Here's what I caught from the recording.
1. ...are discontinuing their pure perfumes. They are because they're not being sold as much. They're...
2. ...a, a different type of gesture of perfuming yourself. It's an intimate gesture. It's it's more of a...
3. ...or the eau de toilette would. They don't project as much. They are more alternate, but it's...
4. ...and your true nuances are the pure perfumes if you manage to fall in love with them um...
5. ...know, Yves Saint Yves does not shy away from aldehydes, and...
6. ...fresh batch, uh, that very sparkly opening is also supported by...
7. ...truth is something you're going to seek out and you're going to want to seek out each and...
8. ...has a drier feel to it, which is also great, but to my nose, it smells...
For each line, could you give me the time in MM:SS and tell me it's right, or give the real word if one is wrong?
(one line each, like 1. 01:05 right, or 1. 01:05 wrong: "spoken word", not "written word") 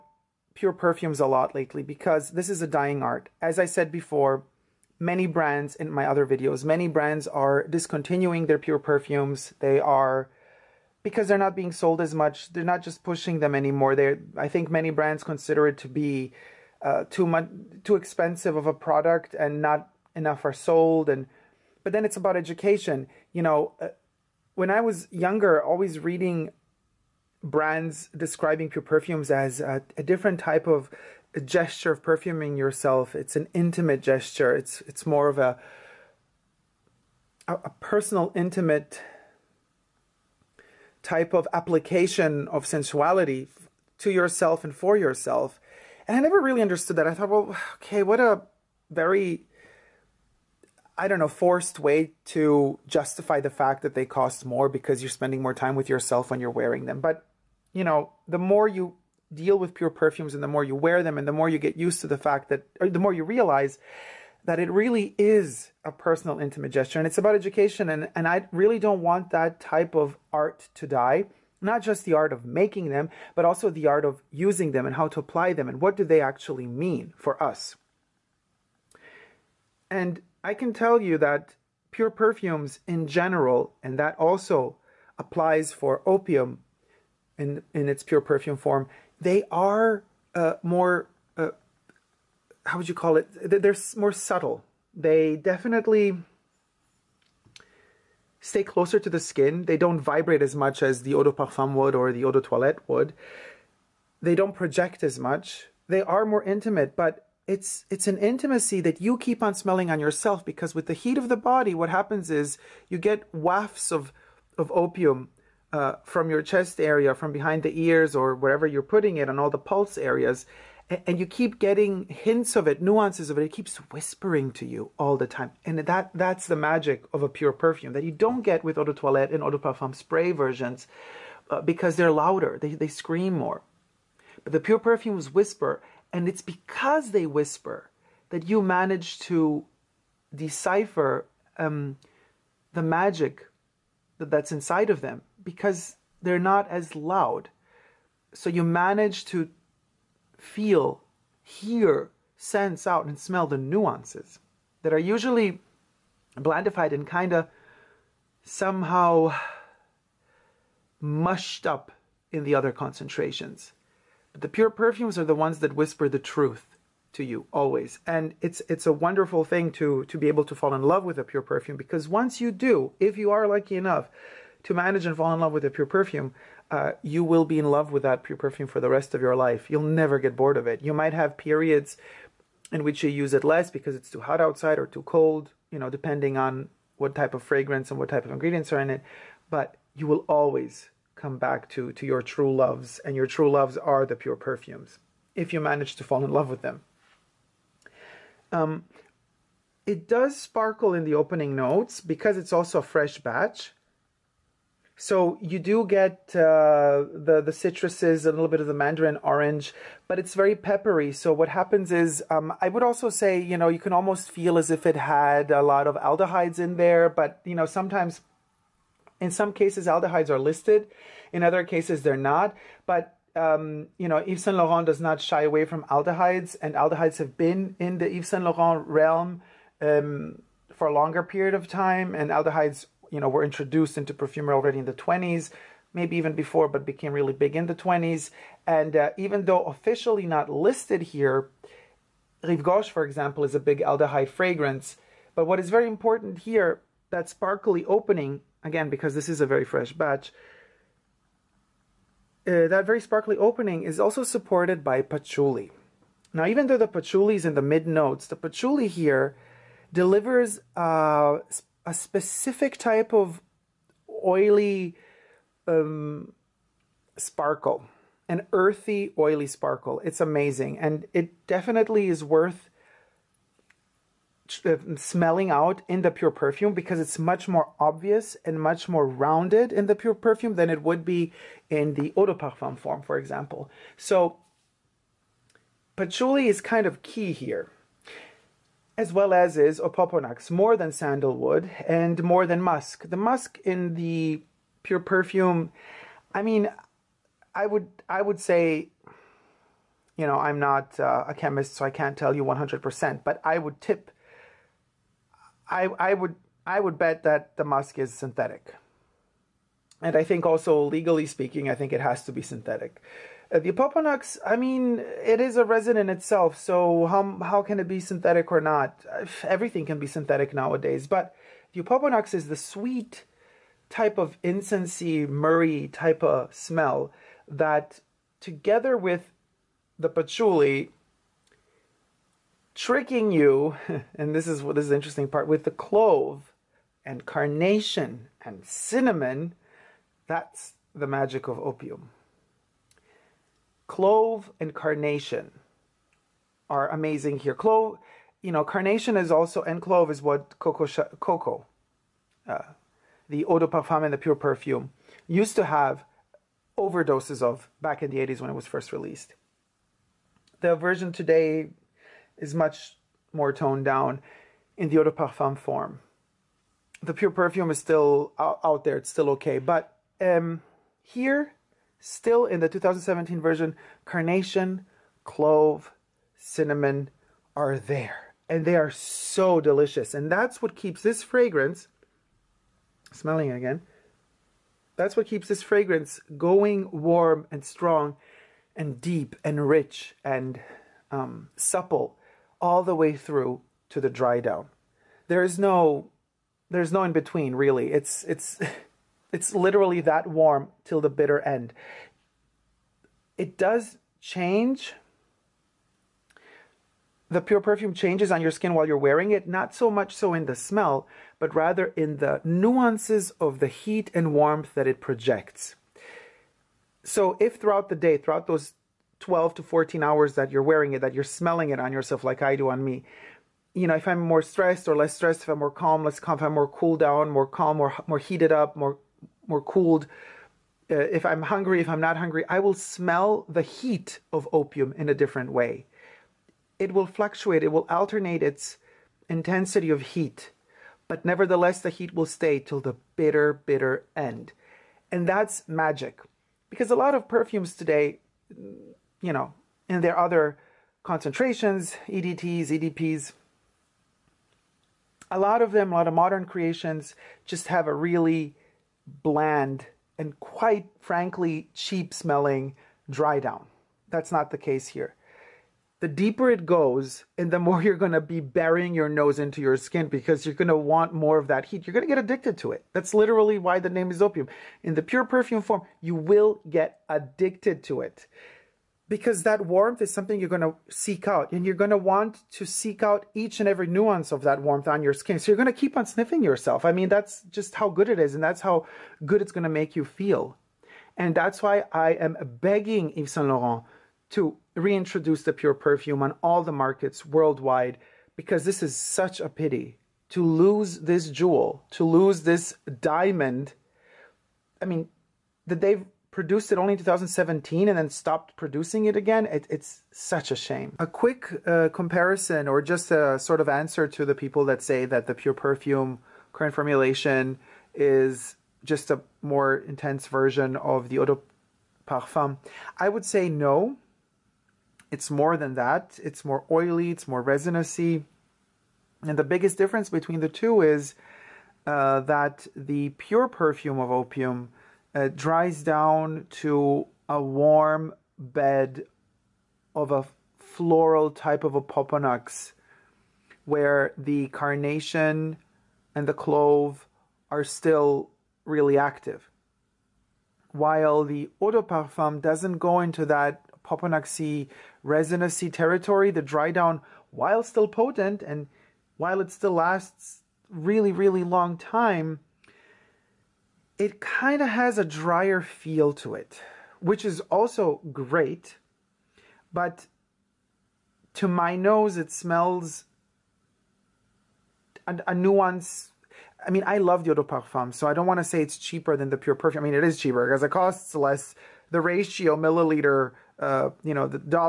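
1. 00:07 right
2. 00:29 right
3. 01:41 wrong: "intimate", not "alternate"
4. 03:13 wrong: "loves", not "nuances"
5. 03:44 wrong: "Laurent", not "Yves"
6. 04:09 right
7. 07:59 wrong: "warmth", not "truth"
8. 09:24 right.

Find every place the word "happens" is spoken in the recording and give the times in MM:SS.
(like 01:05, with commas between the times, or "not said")
01:51, 03:31.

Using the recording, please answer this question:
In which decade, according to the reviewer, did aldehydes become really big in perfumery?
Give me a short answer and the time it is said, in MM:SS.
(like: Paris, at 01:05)
the 20s, at 03:56.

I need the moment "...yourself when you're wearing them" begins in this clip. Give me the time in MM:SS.
00:55.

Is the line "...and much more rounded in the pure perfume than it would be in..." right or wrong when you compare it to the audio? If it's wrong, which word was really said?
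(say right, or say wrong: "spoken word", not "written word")
right.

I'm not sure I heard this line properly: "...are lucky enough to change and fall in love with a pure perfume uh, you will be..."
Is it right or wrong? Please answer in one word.
wrong.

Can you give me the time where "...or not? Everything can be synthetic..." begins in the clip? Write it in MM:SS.
05:18.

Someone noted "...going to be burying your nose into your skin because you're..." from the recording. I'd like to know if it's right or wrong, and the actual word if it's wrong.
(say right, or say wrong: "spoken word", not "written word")
right.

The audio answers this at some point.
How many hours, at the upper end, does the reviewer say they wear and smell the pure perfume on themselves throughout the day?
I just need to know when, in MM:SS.
06:59.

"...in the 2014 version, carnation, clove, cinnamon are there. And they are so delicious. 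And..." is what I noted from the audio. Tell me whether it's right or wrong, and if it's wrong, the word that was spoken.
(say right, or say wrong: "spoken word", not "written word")
wrong: "2017", not "2014".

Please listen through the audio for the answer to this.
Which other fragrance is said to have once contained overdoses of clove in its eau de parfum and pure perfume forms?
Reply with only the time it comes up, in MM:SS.
05:50.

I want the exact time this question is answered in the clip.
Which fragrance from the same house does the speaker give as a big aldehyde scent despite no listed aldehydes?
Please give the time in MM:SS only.
04:02.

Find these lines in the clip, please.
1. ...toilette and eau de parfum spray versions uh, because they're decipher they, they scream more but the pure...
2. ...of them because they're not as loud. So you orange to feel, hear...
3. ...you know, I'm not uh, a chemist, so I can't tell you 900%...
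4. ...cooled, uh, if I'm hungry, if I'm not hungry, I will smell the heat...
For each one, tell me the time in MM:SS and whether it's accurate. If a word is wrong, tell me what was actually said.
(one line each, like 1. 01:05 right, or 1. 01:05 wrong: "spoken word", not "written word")
1. 02:08 wrong: "louder", not "decipher"
2. 02:24 wrong: "manage", not "orange"
3. 05:00 wrong: "100", not "900"
4. 07:09 right.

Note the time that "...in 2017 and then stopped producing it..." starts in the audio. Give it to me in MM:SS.
08:26.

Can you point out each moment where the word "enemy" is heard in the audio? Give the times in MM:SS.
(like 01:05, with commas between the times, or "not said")
not said.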